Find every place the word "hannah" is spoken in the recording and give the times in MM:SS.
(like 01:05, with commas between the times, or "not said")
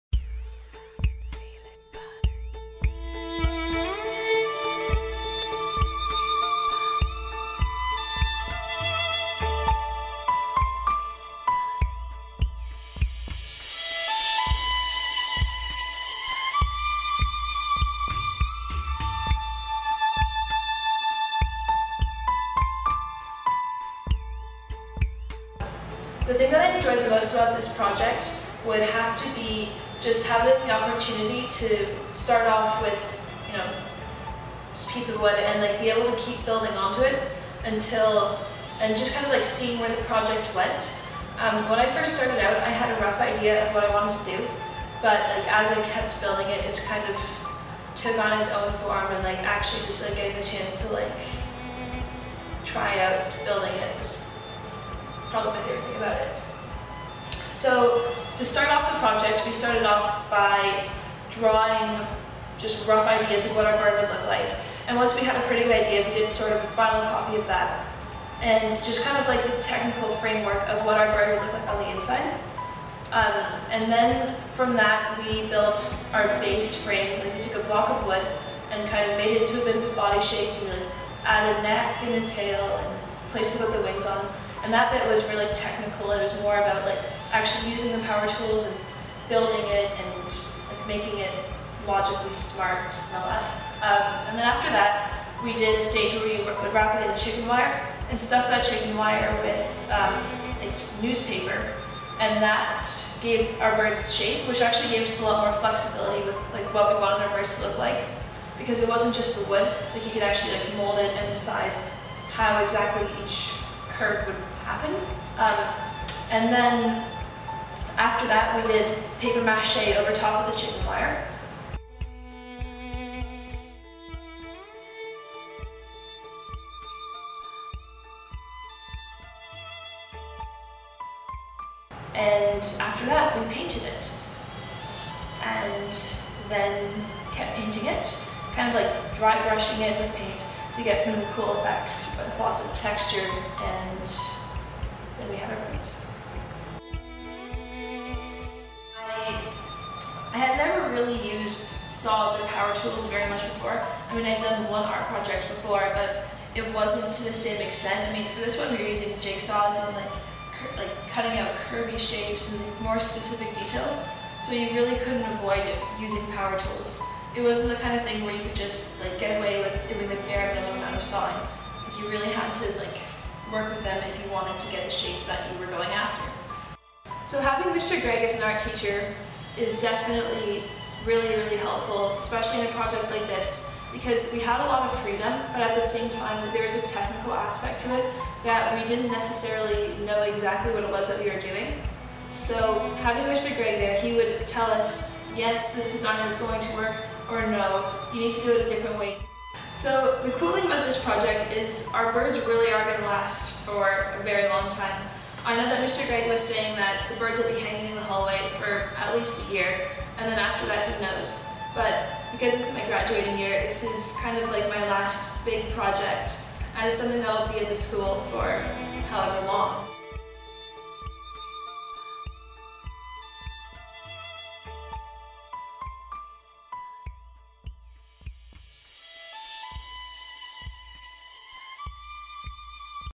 not said.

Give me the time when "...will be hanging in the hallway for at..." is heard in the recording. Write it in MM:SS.
03:27.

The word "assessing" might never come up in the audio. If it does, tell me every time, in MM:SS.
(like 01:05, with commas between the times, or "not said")
not said.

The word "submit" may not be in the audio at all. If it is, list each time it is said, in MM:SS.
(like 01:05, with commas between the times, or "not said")
not said.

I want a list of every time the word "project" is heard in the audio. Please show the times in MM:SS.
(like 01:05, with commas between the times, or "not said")
00:27, 00:40, 00:58, 02:35, 03:02, 03:21, 03:35.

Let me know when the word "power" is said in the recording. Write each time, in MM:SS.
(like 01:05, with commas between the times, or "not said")
01:28, 02:32, 02:46.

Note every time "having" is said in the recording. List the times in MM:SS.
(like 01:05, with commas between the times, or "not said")
00:30, 02:57, 03:13.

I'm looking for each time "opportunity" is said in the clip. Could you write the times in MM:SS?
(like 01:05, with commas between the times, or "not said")
00:30.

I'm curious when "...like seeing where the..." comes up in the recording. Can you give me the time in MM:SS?
00:39.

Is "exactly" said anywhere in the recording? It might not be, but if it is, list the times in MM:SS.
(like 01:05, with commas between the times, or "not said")
01:52, 03:10.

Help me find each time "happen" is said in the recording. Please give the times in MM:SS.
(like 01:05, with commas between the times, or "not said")
01:54.